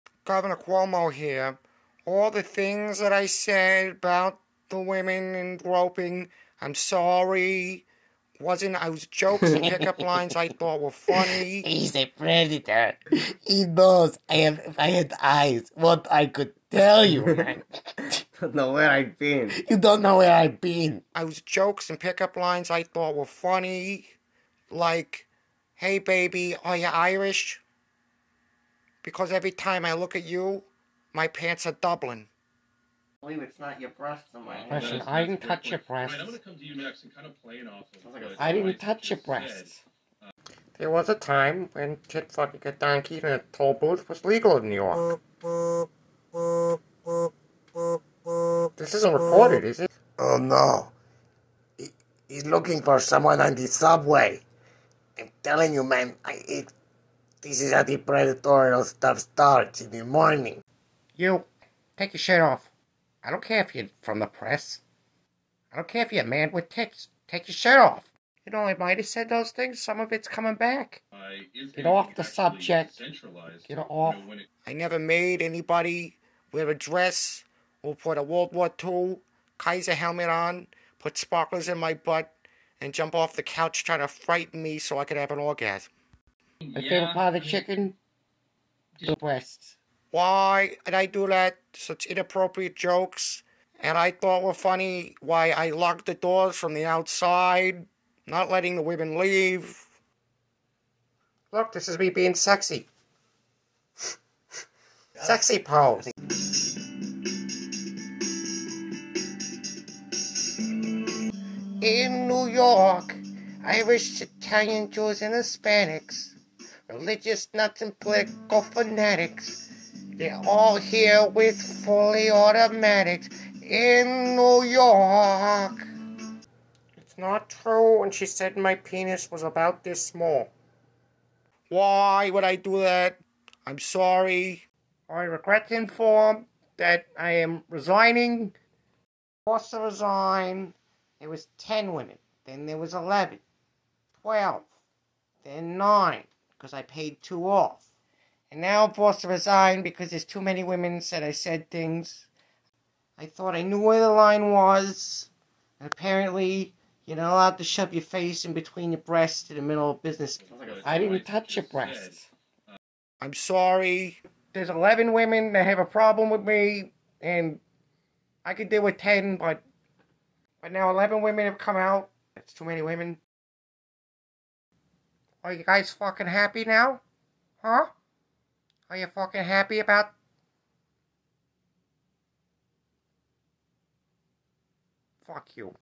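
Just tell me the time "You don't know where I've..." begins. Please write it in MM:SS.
00:19.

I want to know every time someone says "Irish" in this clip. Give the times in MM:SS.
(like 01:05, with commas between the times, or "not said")
00:26, 01:53.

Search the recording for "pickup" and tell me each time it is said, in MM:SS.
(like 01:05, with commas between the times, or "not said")
00:09, 00:21.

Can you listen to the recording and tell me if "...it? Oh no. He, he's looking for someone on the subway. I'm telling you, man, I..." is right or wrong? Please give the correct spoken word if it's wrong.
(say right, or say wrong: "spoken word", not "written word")
right.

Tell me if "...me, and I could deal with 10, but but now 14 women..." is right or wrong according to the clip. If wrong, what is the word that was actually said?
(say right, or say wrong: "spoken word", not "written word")
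wrong: "11", not "14".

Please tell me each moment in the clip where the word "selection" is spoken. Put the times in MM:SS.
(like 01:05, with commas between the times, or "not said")
not said.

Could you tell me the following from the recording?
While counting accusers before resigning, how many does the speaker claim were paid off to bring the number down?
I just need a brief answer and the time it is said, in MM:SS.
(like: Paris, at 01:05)
2, at 02:27.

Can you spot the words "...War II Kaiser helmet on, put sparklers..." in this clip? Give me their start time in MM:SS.
01:18.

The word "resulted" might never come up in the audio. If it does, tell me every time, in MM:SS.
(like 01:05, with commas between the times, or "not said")
not said.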